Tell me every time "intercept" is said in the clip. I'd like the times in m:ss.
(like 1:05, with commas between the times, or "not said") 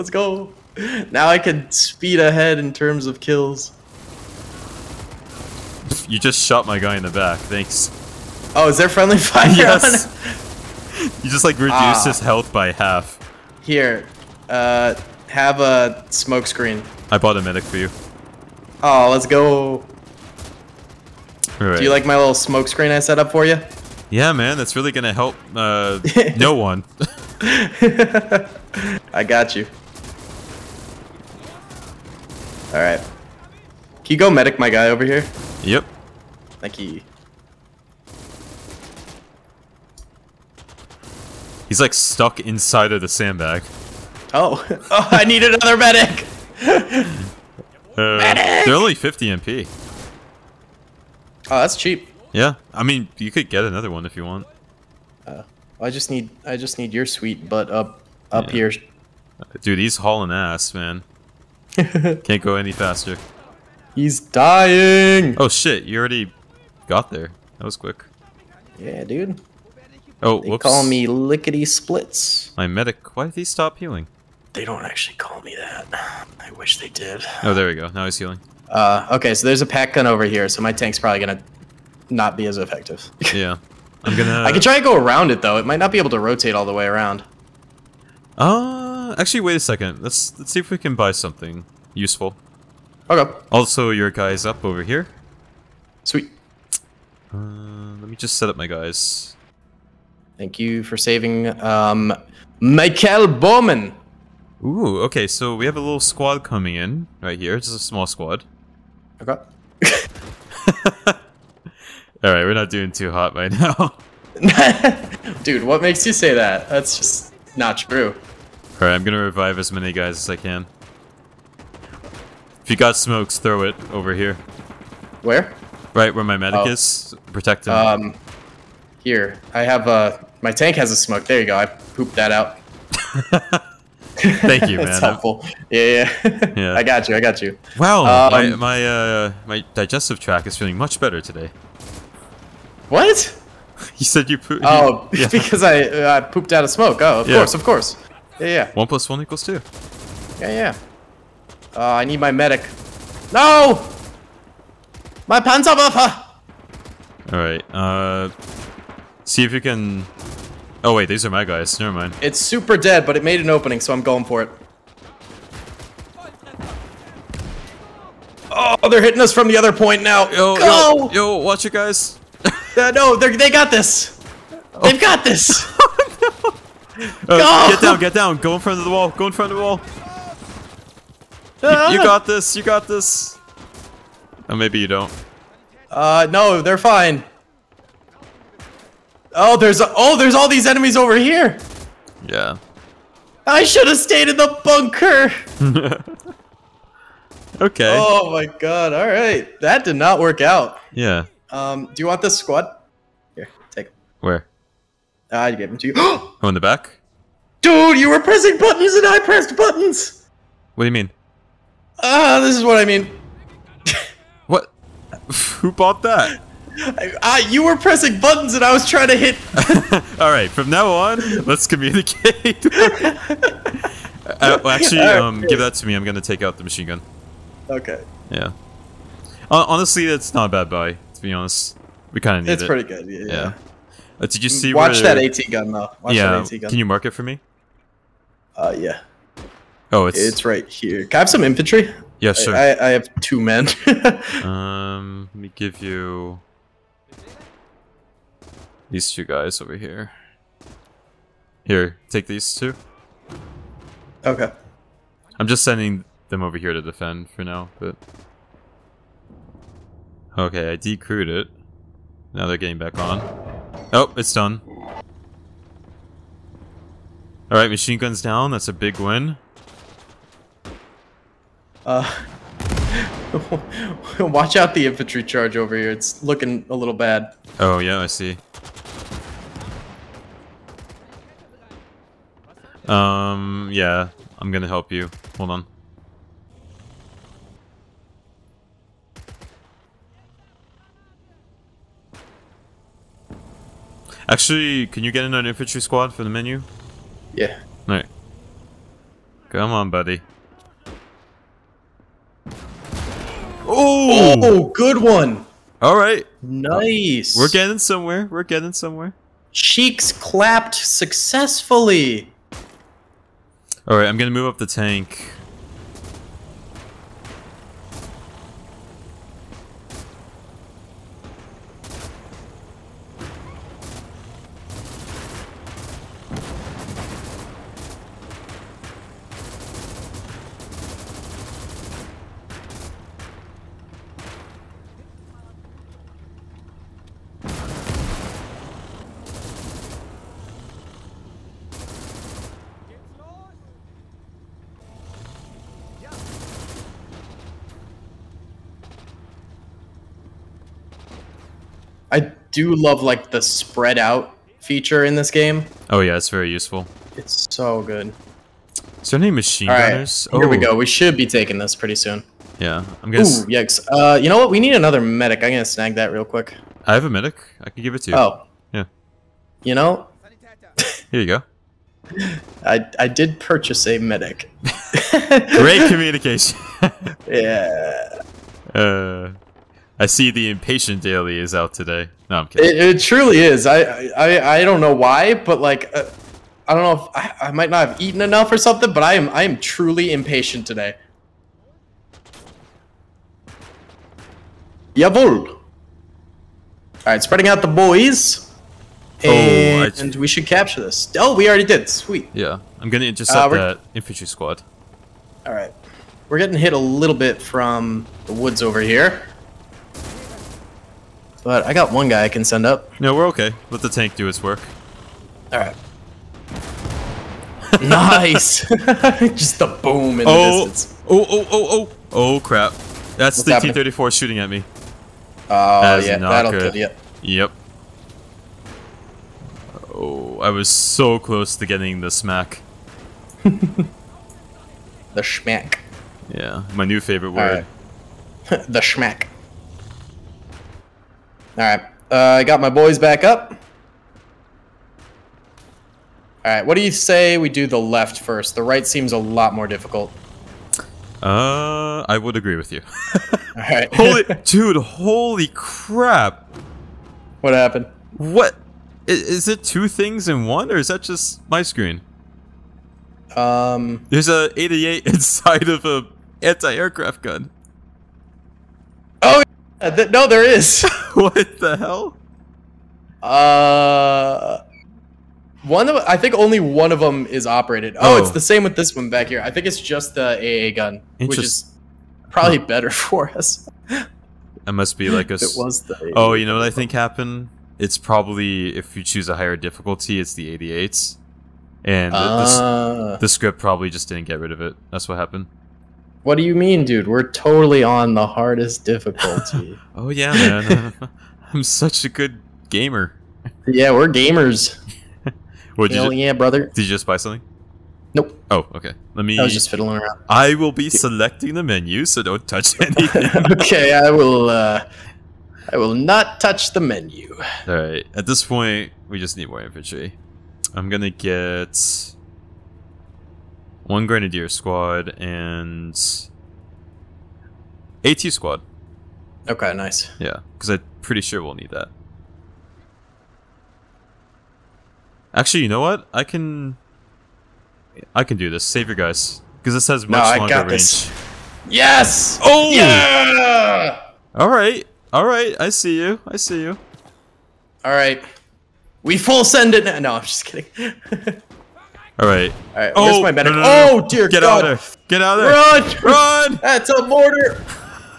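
6:43.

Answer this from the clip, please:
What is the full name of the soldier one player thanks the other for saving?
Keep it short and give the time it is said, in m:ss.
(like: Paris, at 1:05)
Michael Bowman, at 1:42.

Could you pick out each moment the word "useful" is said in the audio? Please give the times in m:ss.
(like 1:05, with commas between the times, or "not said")
1:31, 5:56.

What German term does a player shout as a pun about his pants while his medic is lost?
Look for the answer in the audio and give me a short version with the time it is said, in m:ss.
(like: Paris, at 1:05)
Panzerwaffe, at 2:35.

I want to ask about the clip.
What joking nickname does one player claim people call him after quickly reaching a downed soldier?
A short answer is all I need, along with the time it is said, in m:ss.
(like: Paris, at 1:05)
Lickety Splits, at 1:11.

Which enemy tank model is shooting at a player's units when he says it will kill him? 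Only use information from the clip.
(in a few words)
T-34.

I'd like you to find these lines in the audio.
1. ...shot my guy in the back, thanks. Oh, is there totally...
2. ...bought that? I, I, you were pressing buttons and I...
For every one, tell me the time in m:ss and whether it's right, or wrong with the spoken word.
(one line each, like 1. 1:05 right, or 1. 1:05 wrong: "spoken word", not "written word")
1. 0:06 wrong: "friendly", not "totally"
2. 3:35 right.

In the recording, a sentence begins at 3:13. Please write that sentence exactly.
I should have stayed in the bunker.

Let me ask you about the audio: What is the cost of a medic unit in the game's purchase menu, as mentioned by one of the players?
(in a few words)
50 MP.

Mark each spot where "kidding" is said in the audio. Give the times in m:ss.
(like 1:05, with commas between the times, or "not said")
6:22, 9:10.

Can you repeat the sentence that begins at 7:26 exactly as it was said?
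Alright, what do you say we do the left first?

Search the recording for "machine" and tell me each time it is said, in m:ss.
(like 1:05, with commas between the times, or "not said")
3:46, 4:27, 5:59.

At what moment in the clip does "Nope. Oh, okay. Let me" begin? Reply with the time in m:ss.
8:28.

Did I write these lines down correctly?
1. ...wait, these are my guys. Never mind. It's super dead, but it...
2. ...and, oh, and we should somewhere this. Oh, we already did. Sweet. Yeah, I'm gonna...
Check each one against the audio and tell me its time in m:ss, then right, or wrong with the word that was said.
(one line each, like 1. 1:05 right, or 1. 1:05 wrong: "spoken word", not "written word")
1. 2:40 right
2. 6:39 wrong: "capture", not "somewhere".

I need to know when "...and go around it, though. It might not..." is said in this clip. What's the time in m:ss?
1:24.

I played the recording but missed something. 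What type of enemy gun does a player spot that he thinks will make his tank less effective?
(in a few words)
PaK gun.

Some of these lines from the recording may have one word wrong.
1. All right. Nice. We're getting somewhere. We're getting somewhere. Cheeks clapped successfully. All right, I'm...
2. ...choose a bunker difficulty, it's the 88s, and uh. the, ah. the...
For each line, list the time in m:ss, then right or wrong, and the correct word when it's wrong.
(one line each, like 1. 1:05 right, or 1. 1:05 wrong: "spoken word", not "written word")
1. 5:05 right
2. 8:09 wrong: "higher", not "bunker".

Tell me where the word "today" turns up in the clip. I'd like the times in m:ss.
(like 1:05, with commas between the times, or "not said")
2:21, 6:21, 6:30.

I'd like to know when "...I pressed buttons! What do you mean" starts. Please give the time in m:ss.
3:29.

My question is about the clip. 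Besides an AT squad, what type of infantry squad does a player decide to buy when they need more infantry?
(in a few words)
Grenadier squad.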